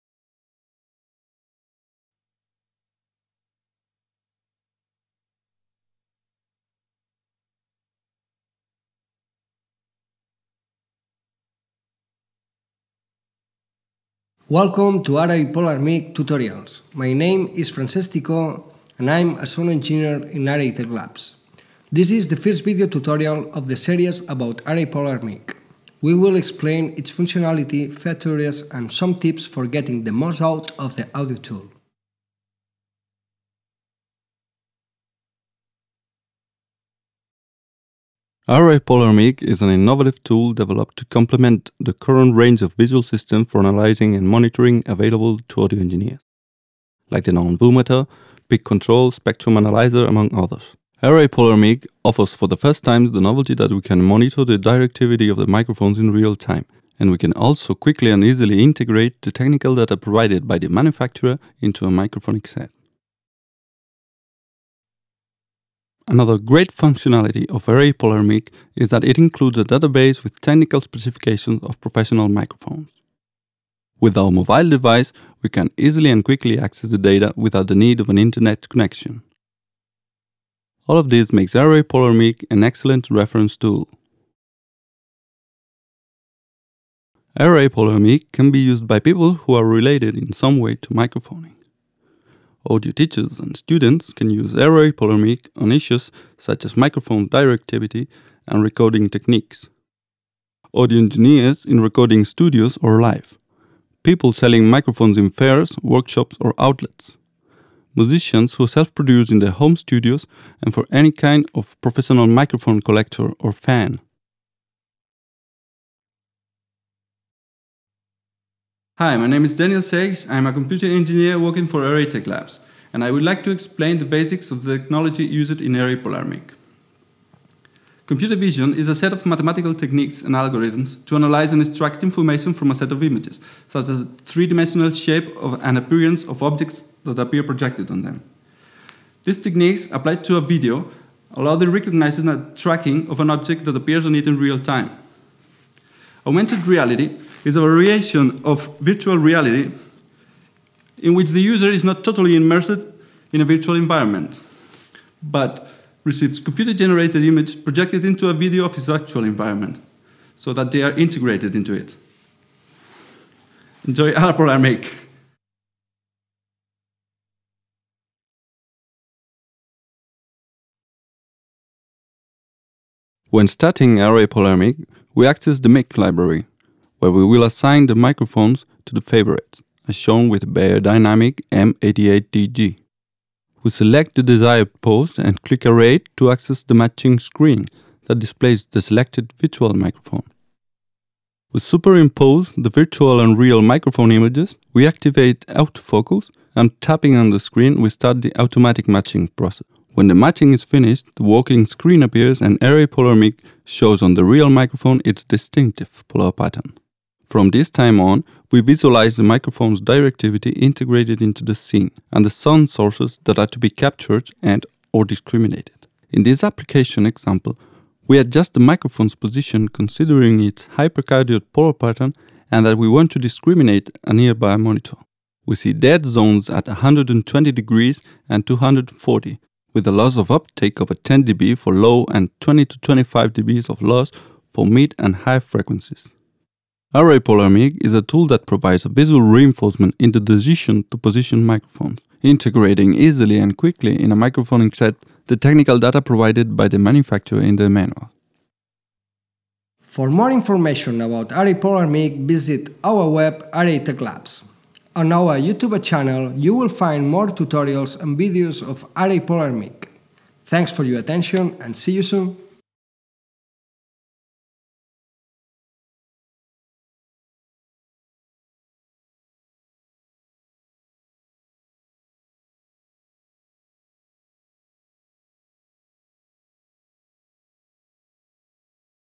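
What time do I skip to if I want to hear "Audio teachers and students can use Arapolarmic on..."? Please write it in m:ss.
1:32.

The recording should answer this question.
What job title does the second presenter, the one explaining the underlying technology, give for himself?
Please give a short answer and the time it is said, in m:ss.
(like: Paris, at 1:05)
Computer engineer, at 2:00.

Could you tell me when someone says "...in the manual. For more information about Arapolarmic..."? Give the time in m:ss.
4:07.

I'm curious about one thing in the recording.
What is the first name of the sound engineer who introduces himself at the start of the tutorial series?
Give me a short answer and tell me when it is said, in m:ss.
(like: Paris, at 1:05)
Francesco, at 0:17.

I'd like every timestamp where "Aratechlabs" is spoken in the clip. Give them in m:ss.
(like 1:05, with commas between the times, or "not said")
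0:20, 2:01, 4:13.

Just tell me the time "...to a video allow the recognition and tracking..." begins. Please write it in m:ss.
2:20.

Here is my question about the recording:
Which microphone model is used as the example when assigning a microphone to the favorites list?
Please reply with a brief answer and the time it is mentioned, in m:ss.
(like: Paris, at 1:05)
M88TG, at 3:01.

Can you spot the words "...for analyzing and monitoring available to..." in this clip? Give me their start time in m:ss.
0:43.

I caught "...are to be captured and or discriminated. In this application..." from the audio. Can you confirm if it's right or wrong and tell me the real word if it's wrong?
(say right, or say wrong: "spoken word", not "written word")
right.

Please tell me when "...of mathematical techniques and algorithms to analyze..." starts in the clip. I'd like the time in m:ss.
2:09.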